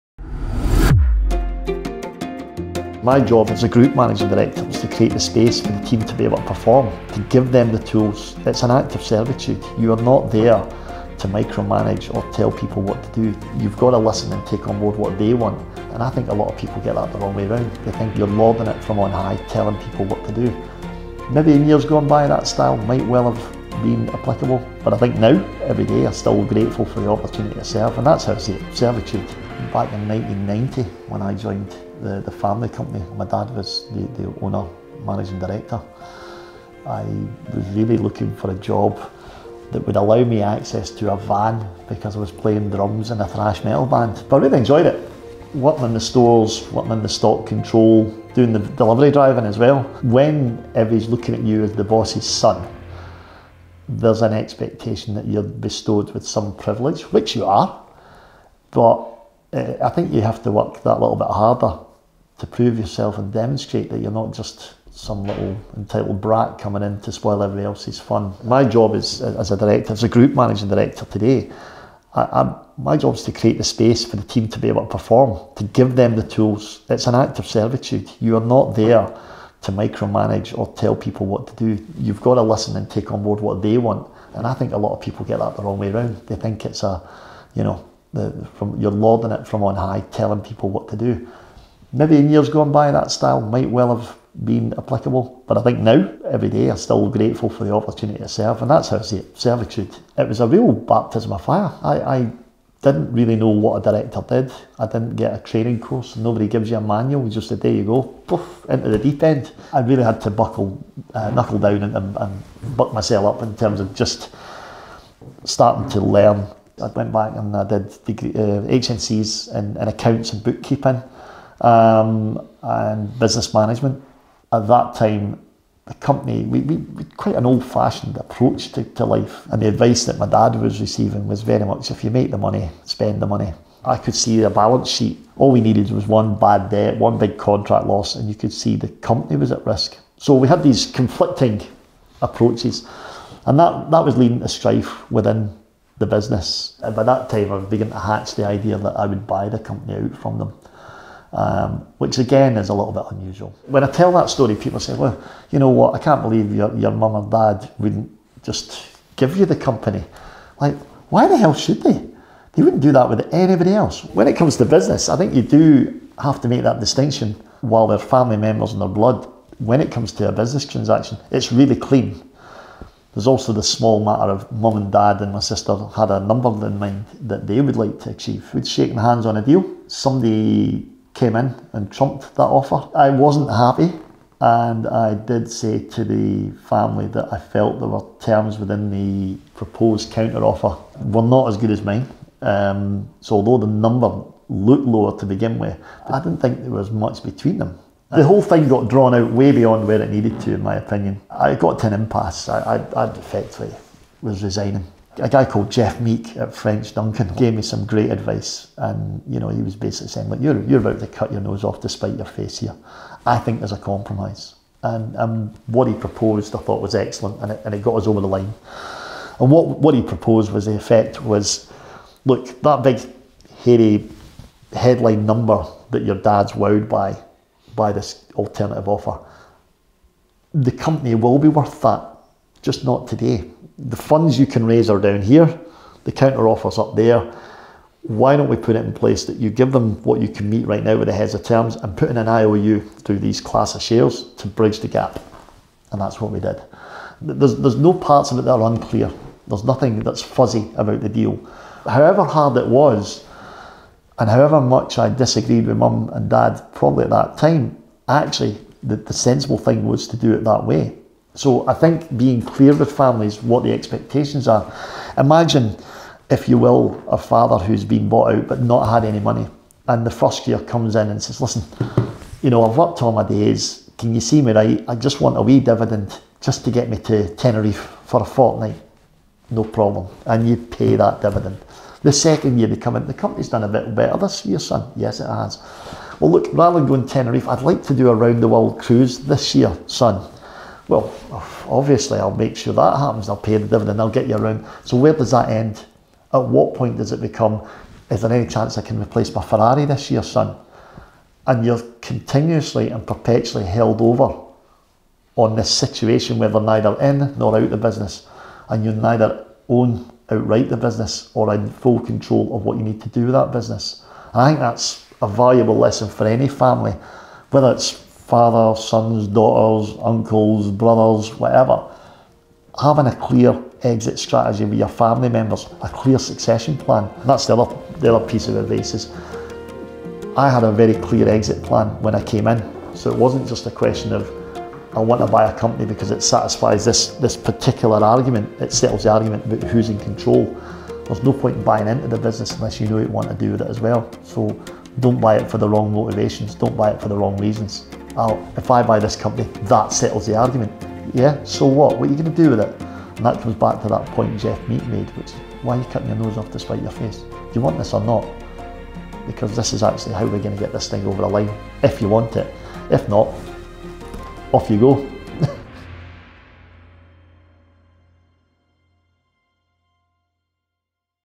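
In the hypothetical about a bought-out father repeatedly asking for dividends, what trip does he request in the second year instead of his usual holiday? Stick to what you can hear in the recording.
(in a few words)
Round the world cruise.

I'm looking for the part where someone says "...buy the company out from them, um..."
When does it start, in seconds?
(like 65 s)
149 s.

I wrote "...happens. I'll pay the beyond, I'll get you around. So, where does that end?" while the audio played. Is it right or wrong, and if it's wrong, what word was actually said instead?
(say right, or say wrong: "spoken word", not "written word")
wrong: "dividend", not "beyond".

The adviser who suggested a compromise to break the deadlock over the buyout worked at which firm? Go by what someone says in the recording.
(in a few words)
French Duncan.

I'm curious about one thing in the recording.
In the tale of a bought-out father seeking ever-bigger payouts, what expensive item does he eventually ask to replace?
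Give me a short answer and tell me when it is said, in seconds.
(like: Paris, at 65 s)
Ferrari, at 299 s.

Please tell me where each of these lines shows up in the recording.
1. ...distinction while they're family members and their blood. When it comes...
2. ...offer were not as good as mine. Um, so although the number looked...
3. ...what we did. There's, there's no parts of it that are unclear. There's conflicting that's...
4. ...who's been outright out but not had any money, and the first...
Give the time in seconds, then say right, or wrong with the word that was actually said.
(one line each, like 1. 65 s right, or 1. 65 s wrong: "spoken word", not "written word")
1. 166 s right
2. 190 s right
3. 246 s wrong: "nothing", not "conflicting"
4. 267 s wrong: "bought", not "outright".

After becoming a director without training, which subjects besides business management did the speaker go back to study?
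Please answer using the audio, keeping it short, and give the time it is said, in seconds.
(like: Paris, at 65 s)
Accounts and bookkeeping, at 119 s.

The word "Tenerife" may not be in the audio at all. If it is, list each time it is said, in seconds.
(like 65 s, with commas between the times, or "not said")
277 s, 287 s.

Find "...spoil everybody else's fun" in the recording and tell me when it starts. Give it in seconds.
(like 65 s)
67 s.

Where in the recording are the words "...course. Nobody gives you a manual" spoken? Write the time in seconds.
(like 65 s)
105 s.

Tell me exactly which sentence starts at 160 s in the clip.
Like, why the hell should they?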